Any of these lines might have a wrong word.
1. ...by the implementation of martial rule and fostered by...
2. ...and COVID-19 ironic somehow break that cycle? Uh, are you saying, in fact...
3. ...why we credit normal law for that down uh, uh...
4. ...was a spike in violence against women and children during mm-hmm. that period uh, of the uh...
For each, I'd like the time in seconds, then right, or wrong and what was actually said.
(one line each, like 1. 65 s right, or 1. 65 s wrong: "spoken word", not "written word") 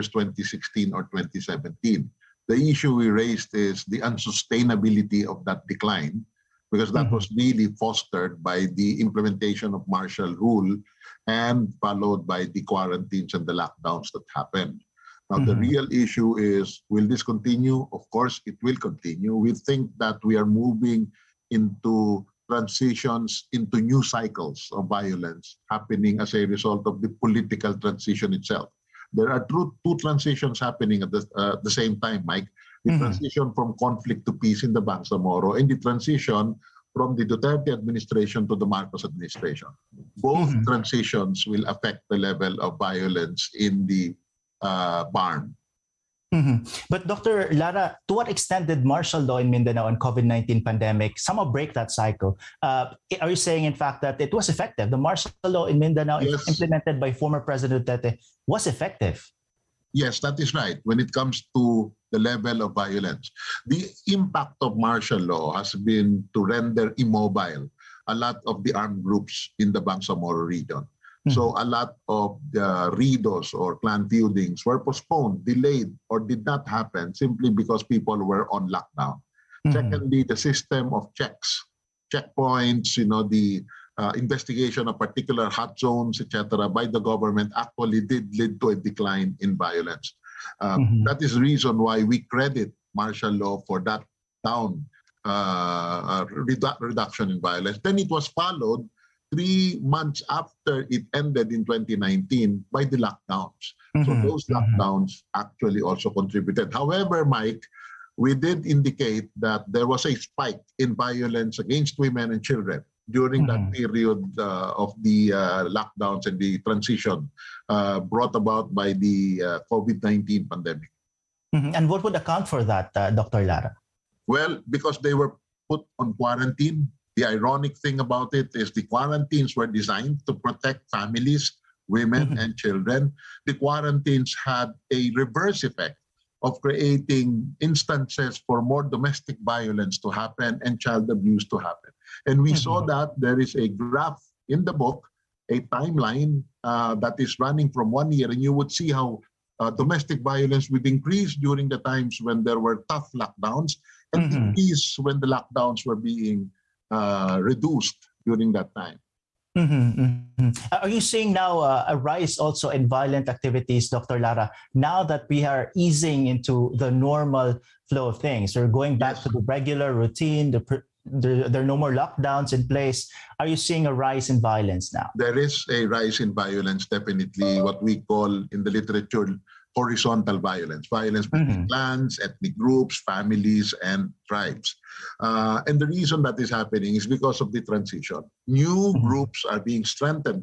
1. 8 s wrong: "followed", not "fostered"
2. 49 s wrong: "pandemic", not "ironic"
3. 91 s wrong: "martial", not "normal"
4. 109 s right.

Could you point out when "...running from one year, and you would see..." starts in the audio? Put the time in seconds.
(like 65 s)
147 s.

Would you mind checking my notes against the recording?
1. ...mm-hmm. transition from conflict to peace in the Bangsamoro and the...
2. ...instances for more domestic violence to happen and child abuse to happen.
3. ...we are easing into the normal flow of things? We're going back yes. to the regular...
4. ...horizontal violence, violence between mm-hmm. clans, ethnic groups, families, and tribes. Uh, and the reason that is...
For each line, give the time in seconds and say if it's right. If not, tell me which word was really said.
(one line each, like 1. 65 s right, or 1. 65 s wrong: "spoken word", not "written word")
1. 32 s right
2. 137 s right
3. 165 s right
4. 179 s right.